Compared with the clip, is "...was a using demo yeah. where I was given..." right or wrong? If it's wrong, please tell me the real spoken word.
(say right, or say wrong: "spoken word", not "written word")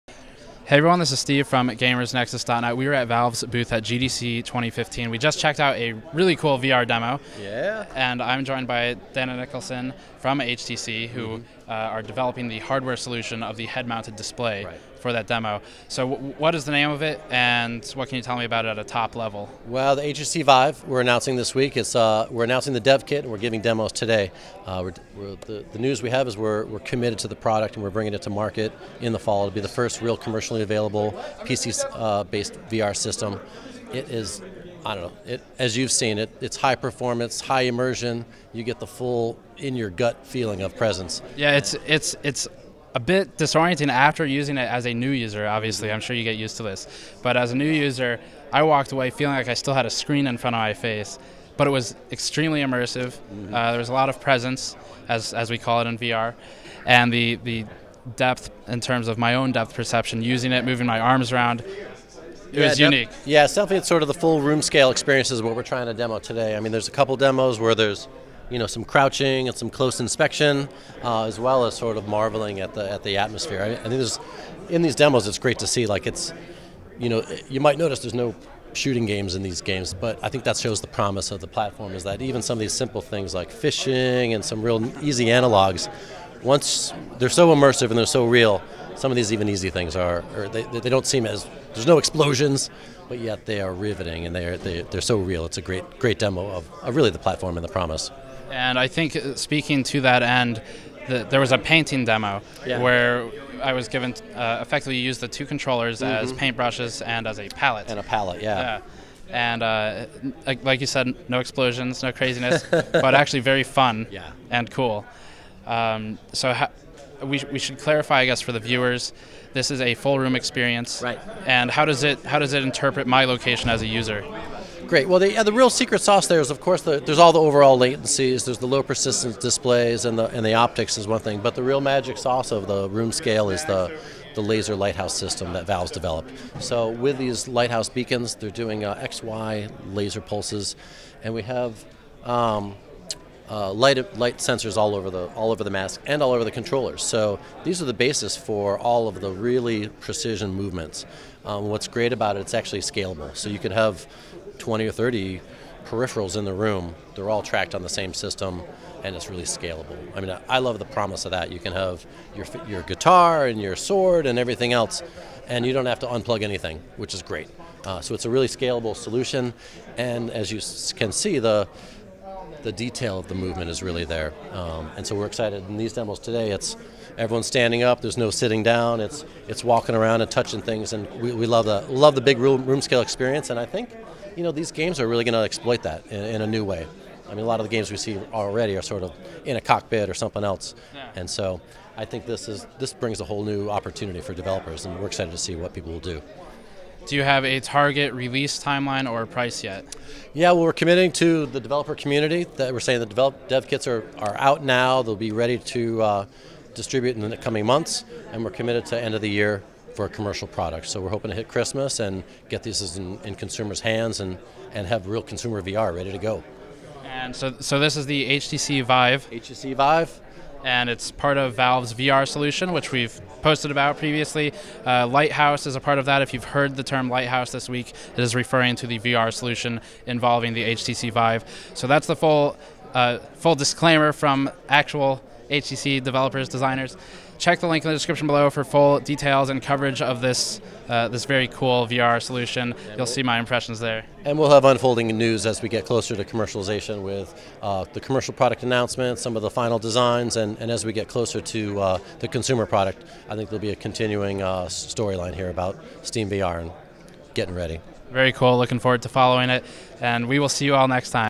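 wrong: "painting", not "using".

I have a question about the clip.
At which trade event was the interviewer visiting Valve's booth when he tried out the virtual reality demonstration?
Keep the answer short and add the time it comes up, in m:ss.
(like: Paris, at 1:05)
GDC 2015, at 0:03.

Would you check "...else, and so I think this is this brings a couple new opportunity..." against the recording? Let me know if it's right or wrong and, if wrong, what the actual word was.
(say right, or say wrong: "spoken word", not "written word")
wrong: "whole", not "couple".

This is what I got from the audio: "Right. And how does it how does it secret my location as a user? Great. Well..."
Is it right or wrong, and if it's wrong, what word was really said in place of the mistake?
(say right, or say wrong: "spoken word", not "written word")
wrong: "interpret", not "secret".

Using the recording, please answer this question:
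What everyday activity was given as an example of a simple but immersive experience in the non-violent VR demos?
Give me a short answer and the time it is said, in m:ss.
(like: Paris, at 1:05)
Fishing, at 1:23.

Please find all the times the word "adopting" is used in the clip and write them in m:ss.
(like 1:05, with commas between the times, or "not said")
not said.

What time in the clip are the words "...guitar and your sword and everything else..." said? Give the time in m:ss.
2:42.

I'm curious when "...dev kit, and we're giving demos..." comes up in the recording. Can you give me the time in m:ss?
0:22.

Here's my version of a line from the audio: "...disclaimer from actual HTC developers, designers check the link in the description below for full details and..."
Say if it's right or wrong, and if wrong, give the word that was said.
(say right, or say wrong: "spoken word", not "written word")
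right.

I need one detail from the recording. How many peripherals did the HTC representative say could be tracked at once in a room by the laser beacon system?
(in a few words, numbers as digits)
20 or 30.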